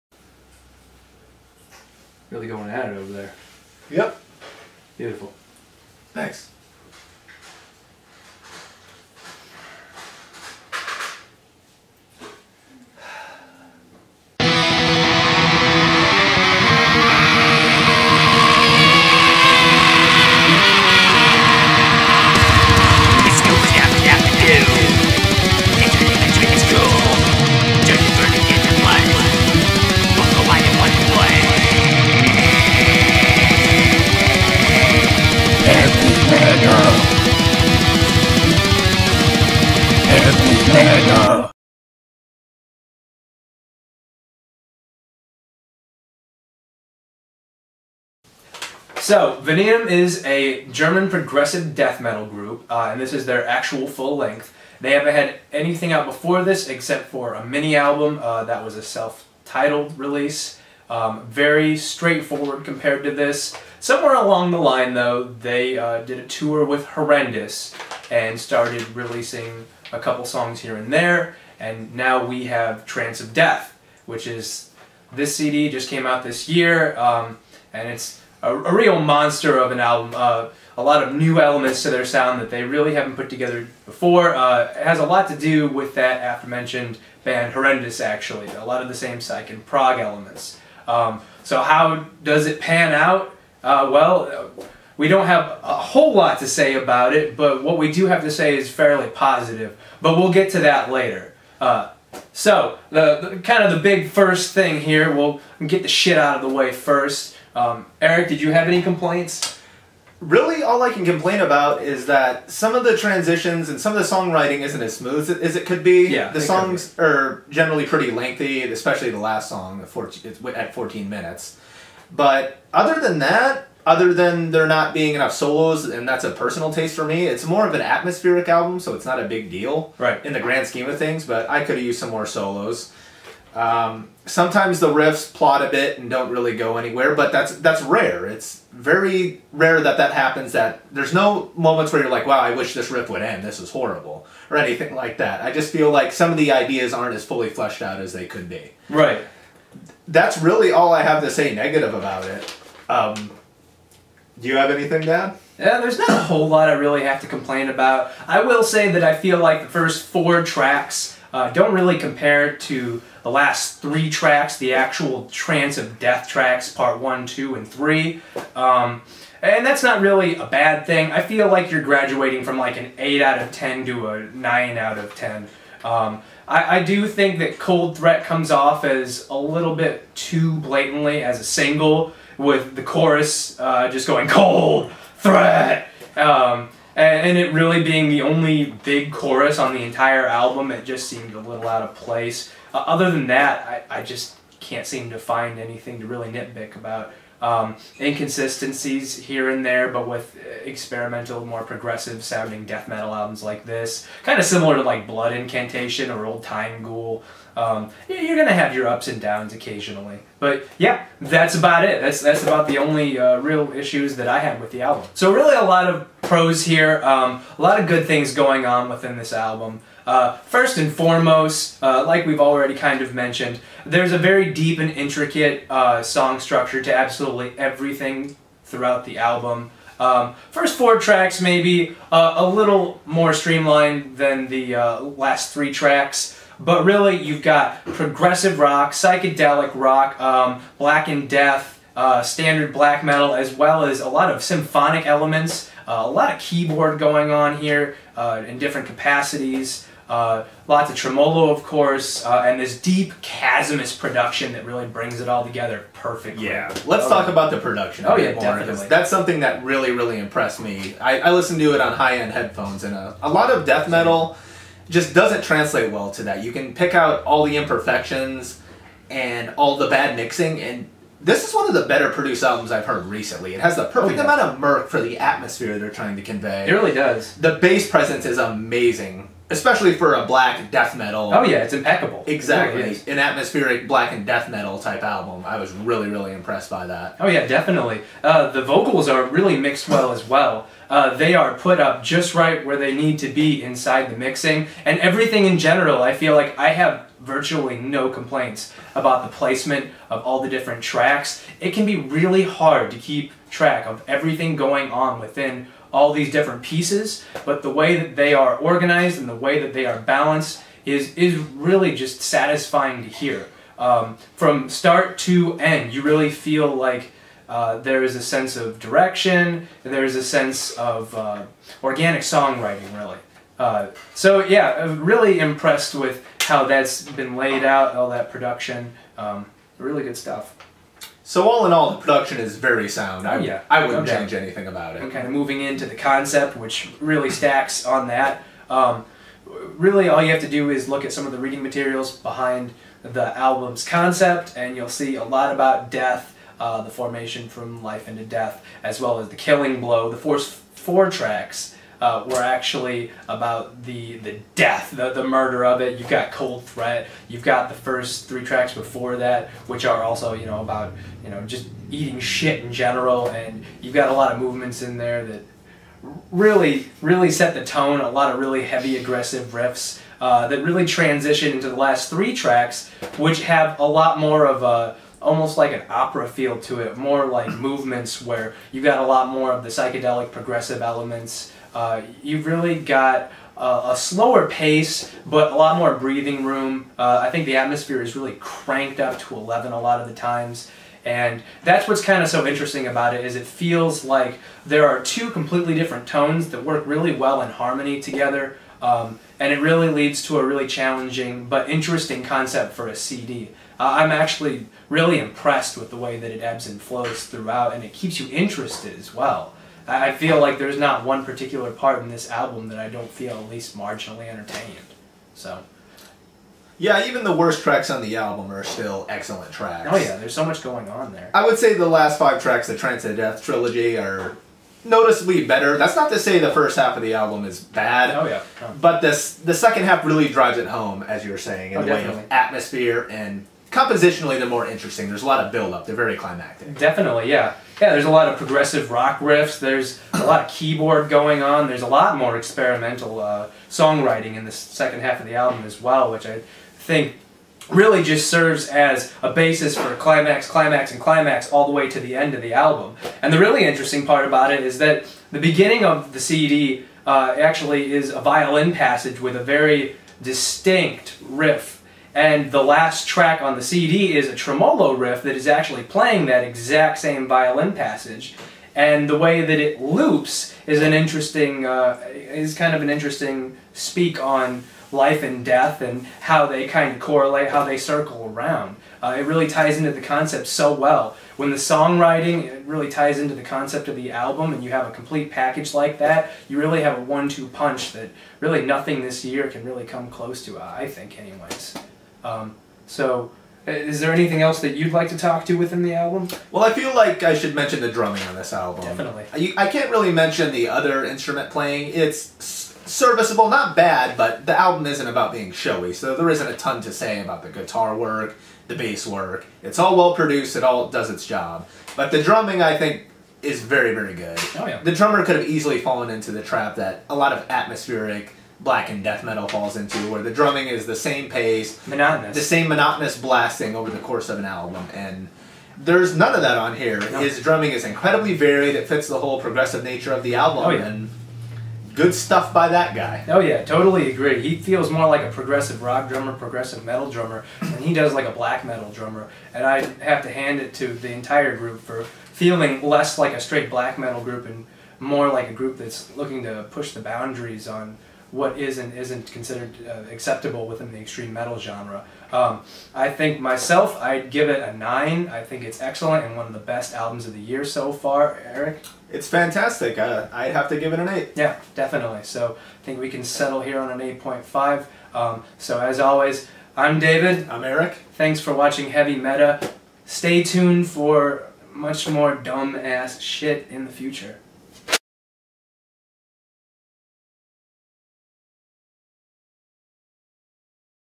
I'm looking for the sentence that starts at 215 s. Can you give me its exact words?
So really, a lot of pros here, um, a lot of good things going on within this album.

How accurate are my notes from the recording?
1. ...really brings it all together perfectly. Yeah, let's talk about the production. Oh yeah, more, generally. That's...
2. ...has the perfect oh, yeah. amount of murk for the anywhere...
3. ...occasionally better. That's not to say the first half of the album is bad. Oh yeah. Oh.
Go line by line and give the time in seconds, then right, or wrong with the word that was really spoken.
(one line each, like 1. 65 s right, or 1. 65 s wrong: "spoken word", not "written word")
1. 254 s wrong: "definitely", not "generally"
2. 273 s wrong: "atmosphere", not "anywhere"
3. 424 s wrong: "noticeably", not "occasionally".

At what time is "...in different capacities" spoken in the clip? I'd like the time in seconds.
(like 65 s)
248 s.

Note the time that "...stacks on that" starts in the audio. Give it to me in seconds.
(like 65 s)
337 s.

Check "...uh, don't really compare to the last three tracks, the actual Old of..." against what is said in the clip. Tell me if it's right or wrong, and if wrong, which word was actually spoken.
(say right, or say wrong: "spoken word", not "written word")
wrong: "Trance", not "Old".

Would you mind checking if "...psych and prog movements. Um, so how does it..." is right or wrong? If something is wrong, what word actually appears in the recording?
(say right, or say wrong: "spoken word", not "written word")
wrong: "elements", not "movements".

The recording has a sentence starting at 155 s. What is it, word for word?
Yeah, there's not a whole lot I really have to complain about.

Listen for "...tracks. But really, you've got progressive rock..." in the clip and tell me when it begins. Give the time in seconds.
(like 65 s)
235 s.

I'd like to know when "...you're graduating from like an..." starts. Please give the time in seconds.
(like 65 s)
171 s.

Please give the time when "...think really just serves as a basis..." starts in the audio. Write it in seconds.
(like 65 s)
446 s.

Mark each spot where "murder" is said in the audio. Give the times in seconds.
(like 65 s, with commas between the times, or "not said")
355 s.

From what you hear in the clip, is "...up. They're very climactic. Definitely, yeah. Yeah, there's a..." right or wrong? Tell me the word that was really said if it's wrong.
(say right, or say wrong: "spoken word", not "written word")
right.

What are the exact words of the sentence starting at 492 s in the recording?
Um, so, is there anything else that you'd like to talk to within the album?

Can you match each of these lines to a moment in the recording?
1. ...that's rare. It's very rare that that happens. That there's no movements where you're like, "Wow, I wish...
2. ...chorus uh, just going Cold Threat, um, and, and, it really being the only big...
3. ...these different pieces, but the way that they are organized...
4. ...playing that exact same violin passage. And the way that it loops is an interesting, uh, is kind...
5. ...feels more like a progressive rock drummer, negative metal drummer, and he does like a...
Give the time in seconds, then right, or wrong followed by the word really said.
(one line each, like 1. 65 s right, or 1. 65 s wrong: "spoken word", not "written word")
1. 137 s wrong: "moments", not "movements"
2. 182 s right
3. 306 s right
4. 465 s right
5. 534 s wrong: "progressive", not "negative".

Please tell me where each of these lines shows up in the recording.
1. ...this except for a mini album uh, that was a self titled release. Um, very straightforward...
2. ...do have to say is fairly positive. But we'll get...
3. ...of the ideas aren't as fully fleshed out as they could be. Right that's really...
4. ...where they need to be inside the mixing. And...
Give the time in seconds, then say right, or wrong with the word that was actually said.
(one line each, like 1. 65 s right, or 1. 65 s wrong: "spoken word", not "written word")
1. 56 s right
2. 97 s right
3. 146 s right
4. 292 s right.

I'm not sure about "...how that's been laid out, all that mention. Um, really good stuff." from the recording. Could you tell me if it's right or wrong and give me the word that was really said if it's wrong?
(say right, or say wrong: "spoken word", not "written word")
wrong: "production", not "mention".